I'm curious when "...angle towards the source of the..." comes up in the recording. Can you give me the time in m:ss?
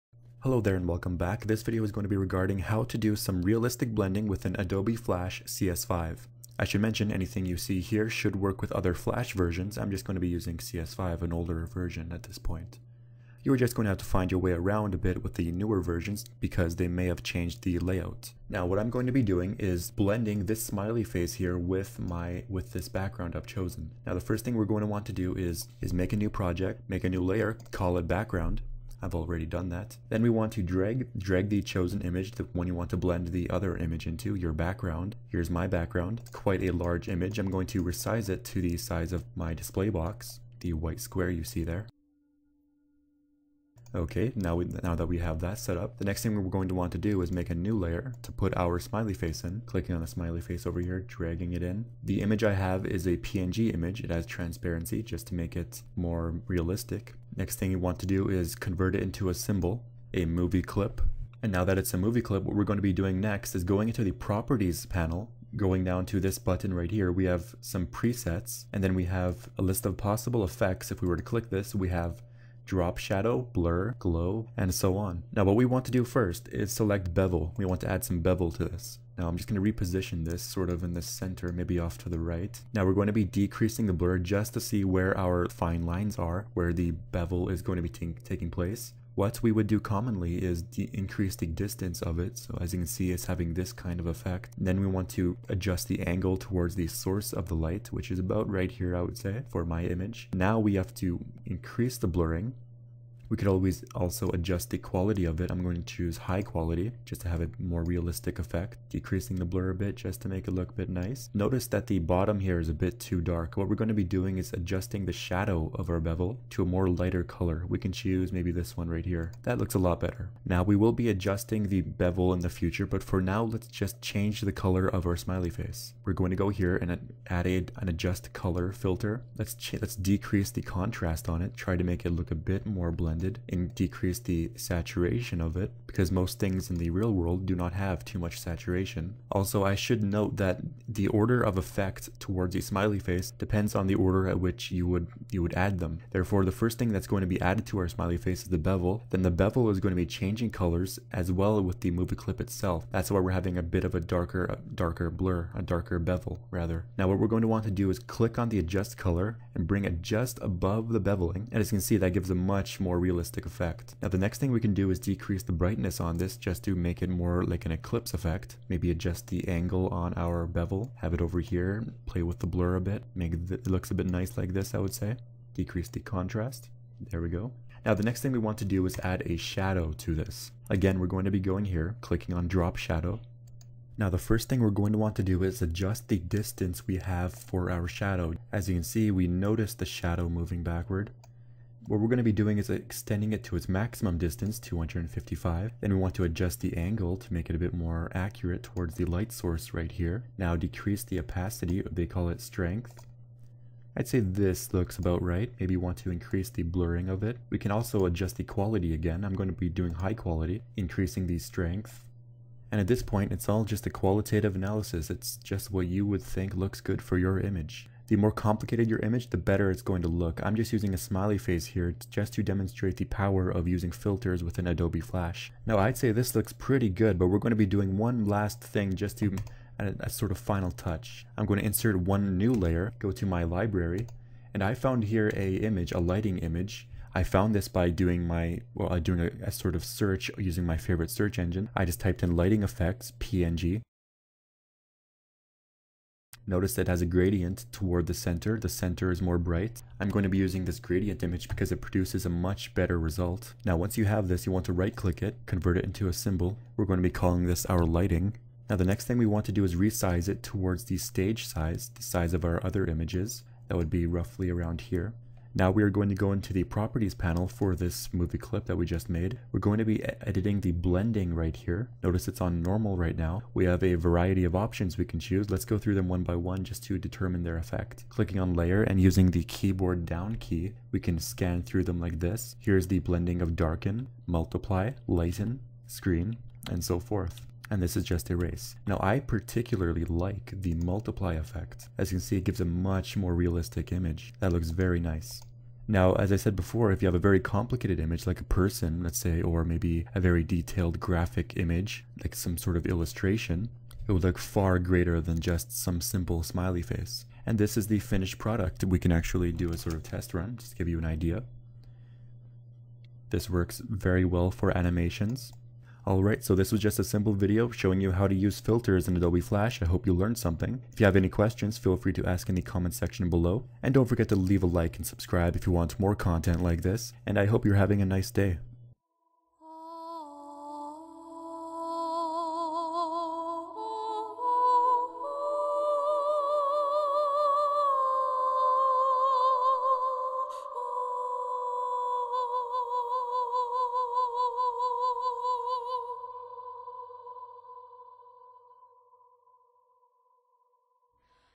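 1:36.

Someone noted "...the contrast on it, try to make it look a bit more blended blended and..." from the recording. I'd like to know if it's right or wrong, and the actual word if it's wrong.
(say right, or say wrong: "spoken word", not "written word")
right.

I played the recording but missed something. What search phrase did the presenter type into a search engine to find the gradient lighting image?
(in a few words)
lighting effects PNG.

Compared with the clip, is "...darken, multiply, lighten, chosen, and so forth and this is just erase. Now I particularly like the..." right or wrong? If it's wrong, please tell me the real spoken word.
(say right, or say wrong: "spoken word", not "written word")
wrong: "screen", not "chosen".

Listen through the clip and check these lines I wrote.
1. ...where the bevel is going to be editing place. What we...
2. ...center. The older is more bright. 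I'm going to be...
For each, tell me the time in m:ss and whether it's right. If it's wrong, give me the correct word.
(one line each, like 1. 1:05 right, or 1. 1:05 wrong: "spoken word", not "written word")
1. 1:26 wrong: "taking", not "editing"
2. 4:08 wrong: "center", not "older".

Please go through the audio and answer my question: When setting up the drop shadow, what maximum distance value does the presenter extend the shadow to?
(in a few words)
255.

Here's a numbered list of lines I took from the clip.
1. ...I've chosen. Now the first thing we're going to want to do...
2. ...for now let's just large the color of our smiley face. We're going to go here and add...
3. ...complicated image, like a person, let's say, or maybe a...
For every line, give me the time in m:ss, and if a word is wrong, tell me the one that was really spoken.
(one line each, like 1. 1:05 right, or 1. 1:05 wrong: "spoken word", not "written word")
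1. 0:23 right
2. 2:03 wrong: "change", not "large"
3. 4:57 right.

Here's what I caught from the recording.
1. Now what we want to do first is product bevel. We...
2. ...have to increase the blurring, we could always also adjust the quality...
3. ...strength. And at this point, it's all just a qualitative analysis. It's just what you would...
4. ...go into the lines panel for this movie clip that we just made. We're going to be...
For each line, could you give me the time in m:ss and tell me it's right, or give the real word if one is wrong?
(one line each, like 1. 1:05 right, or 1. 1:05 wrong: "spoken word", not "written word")
1. 1:15 wrong: "select", not "product"
2. 1:40 right
3. 3:31 right
4. 4:26 wrong: "properties", not "lines".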